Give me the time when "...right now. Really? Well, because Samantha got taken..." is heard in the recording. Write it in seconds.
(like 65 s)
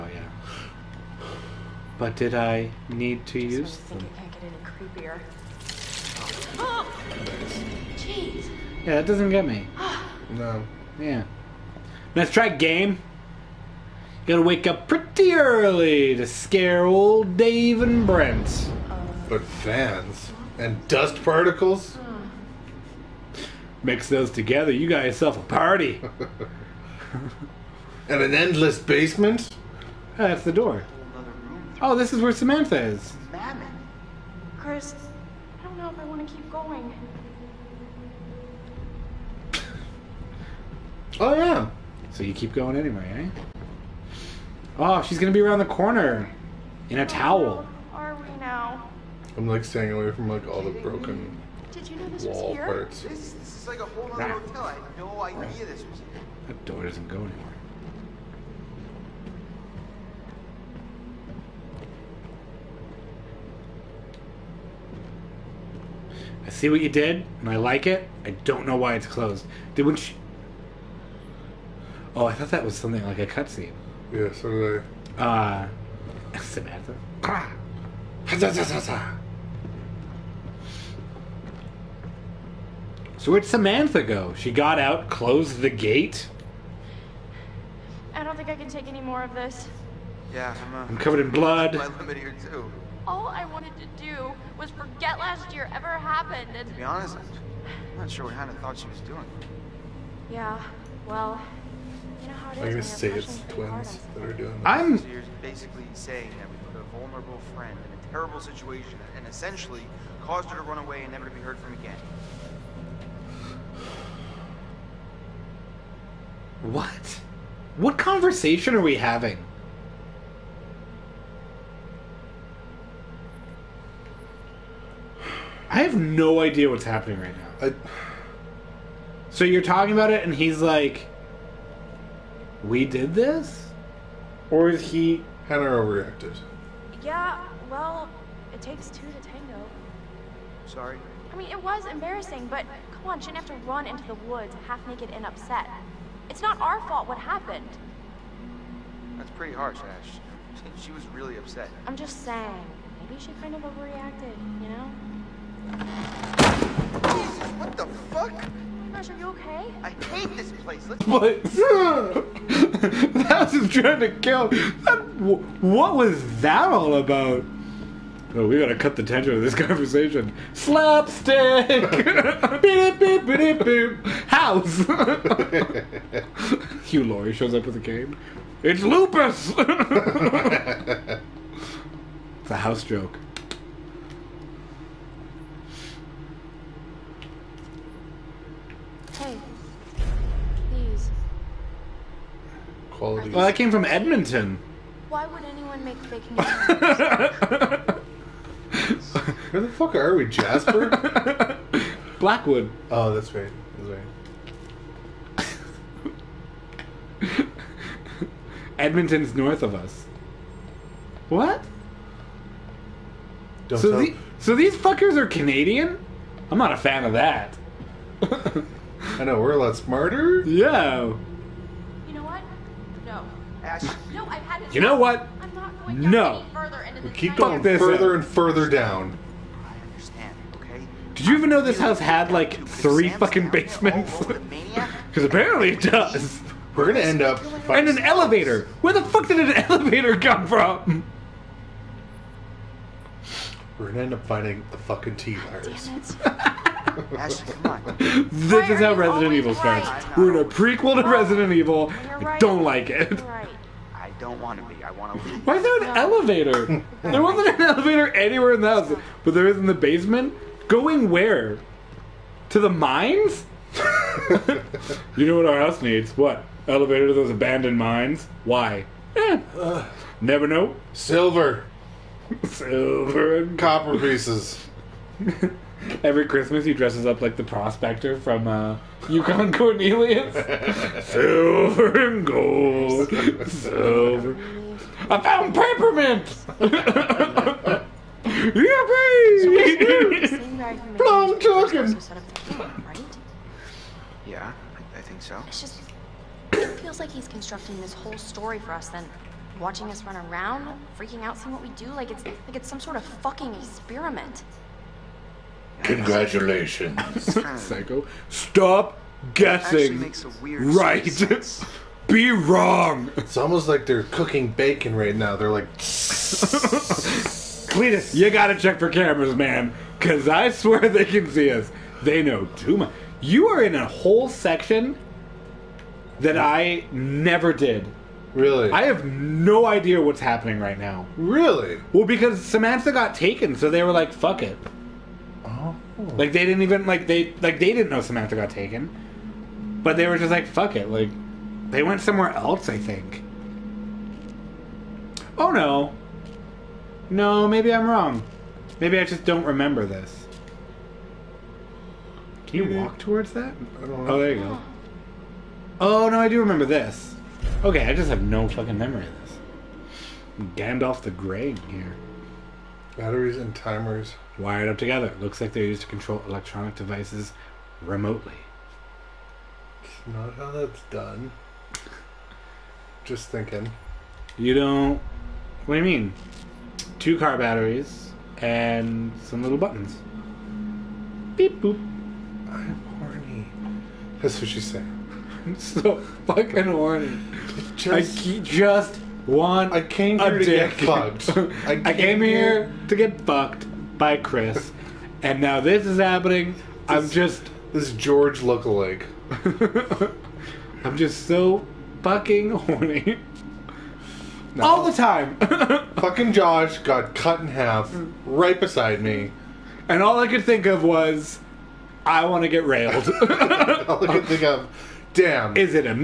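330 s.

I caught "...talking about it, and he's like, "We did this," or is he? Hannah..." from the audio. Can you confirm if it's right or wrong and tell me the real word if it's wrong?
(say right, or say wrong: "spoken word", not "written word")
right.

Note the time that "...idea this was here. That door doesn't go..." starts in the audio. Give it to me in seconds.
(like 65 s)
55 s.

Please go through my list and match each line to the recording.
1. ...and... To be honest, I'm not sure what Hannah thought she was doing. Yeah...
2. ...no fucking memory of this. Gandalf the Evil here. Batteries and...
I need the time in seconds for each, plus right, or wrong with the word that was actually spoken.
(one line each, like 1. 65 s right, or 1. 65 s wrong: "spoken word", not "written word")
1. 96 s right
2. 358 s wrong: "Grey", not "Evil".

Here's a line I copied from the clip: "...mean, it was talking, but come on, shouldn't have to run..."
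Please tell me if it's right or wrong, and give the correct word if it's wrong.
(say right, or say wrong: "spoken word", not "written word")
wrong: "embarrassing", not "talking".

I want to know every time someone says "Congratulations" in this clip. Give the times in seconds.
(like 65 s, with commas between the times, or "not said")
305 s.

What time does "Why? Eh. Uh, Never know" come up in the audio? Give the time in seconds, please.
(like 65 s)
268 s.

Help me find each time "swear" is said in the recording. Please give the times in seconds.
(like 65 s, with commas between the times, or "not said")
320 s.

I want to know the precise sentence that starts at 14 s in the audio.
You gotta wake up pretty early to scare old Dave and Brent.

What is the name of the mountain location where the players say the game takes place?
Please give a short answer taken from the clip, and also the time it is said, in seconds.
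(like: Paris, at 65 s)
Blackwood, at 202 s.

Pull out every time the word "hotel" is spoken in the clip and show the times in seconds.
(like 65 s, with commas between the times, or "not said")
54 s.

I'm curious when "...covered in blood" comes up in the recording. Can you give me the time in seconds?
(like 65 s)
90 s.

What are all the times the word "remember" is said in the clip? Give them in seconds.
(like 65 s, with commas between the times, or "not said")
349 s, 356 s.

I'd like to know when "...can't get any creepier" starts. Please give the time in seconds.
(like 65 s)
4 s.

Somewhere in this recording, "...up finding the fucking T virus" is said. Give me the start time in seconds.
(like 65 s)
244 s.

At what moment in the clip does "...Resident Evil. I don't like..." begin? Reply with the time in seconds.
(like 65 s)
251 s.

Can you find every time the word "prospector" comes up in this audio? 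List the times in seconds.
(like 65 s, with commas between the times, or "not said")
277 s.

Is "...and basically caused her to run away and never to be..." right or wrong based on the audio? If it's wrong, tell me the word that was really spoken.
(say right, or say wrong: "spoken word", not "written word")
wrong: "essentially", not "basically".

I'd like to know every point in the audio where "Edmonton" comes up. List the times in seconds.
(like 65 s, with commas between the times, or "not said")
193 s, 208 s.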